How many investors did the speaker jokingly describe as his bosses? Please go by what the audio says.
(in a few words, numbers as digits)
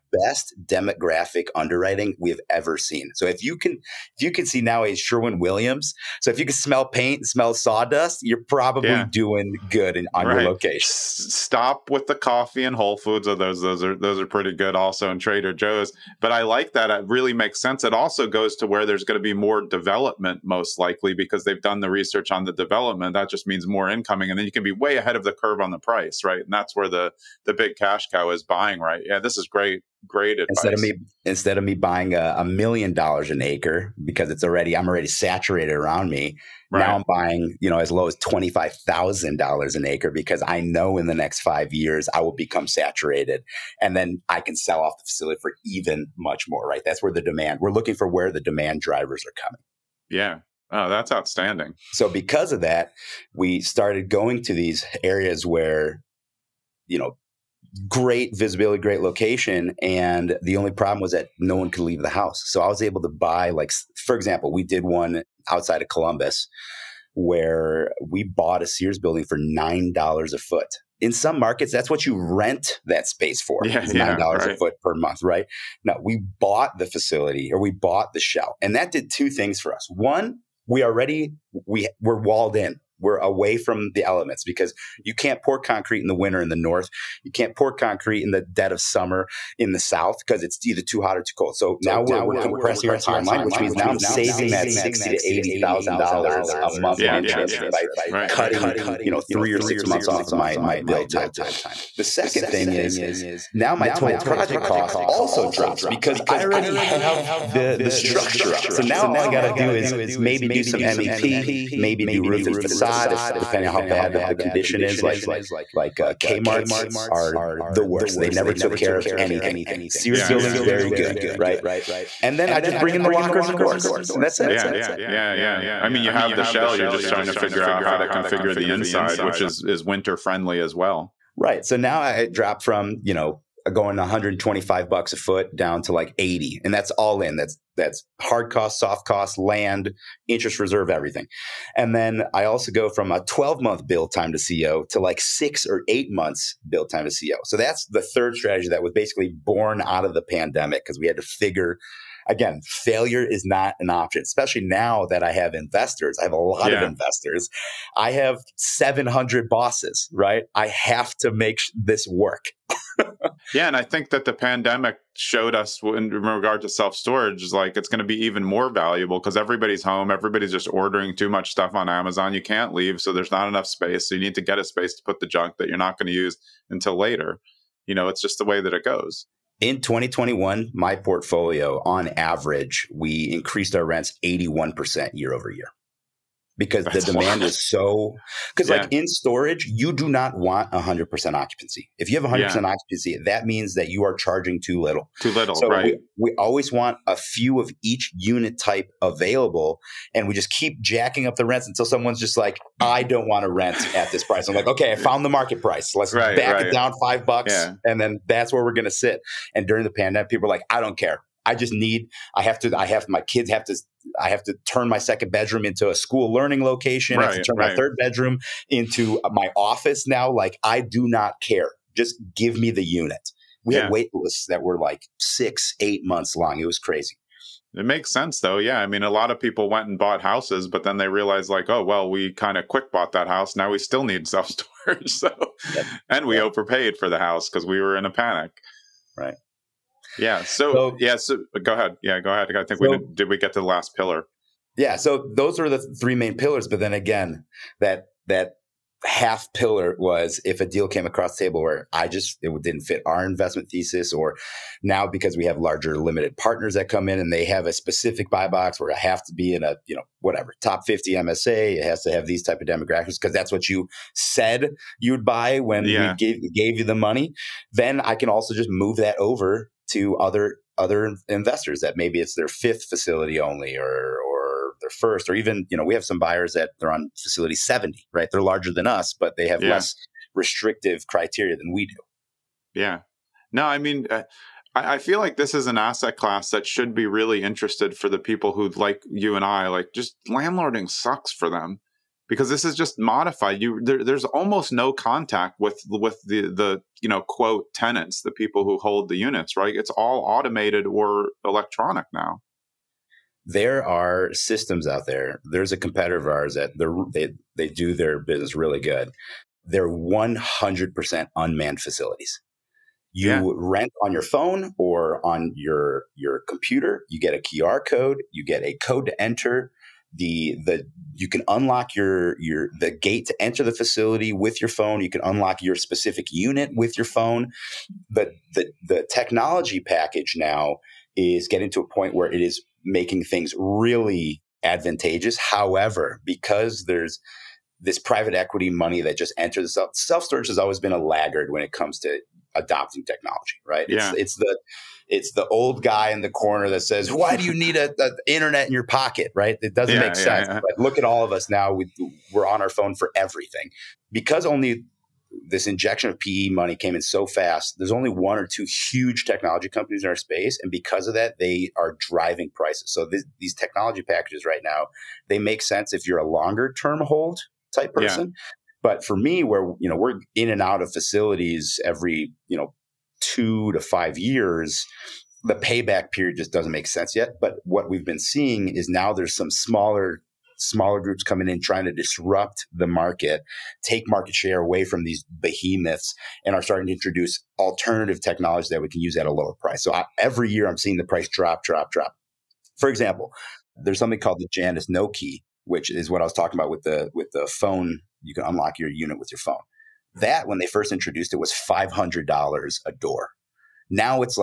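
700.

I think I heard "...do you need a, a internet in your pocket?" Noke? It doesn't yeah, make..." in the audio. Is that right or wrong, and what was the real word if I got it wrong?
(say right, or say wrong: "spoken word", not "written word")
wrong: "Right", not "Noke".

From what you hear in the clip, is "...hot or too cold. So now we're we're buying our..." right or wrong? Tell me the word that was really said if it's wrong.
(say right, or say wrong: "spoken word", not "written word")
wrong: "compressing", not "buying".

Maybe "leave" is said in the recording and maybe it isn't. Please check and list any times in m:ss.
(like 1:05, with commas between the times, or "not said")
1:01, 2:52.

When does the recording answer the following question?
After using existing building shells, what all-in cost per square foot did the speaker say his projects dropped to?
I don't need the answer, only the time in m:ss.
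2:15.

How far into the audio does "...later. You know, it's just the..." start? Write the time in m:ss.
2:56.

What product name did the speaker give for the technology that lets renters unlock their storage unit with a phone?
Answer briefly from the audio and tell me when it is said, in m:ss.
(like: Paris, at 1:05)
Janus Noke, at 6:34.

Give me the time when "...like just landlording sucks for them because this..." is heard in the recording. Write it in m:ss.
4:49.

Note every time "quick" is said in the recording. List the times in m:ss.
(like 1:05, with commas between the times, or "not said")
3:52.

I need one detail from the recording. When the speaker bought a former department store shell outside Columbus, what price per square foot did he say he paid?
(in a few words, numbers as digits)
$9 a foot.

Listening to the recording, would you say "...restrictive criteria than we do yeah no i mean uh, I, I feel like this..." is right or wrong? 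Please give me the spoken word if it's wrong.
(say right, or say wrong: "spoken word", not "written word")
right.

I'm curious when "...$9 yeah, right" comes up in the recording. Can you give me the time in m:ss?
1:13.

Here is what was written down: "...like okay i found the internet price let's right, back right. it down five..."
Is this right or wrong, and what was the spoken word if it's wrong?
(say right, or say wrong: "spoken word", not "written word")
wrong: "market", not "internet".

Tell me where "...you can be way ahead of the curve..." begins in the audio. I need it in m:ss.
0:24.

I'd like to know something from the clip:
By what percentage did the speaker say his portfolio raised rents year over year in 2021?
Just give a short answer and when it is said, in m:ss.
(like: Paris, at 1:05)
81%, at 3:04.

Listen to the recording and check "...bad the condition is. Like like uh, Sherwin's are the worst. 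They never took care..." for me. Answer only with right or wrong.
wrong.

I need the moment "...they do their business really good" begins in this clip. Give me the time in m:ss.
5:07.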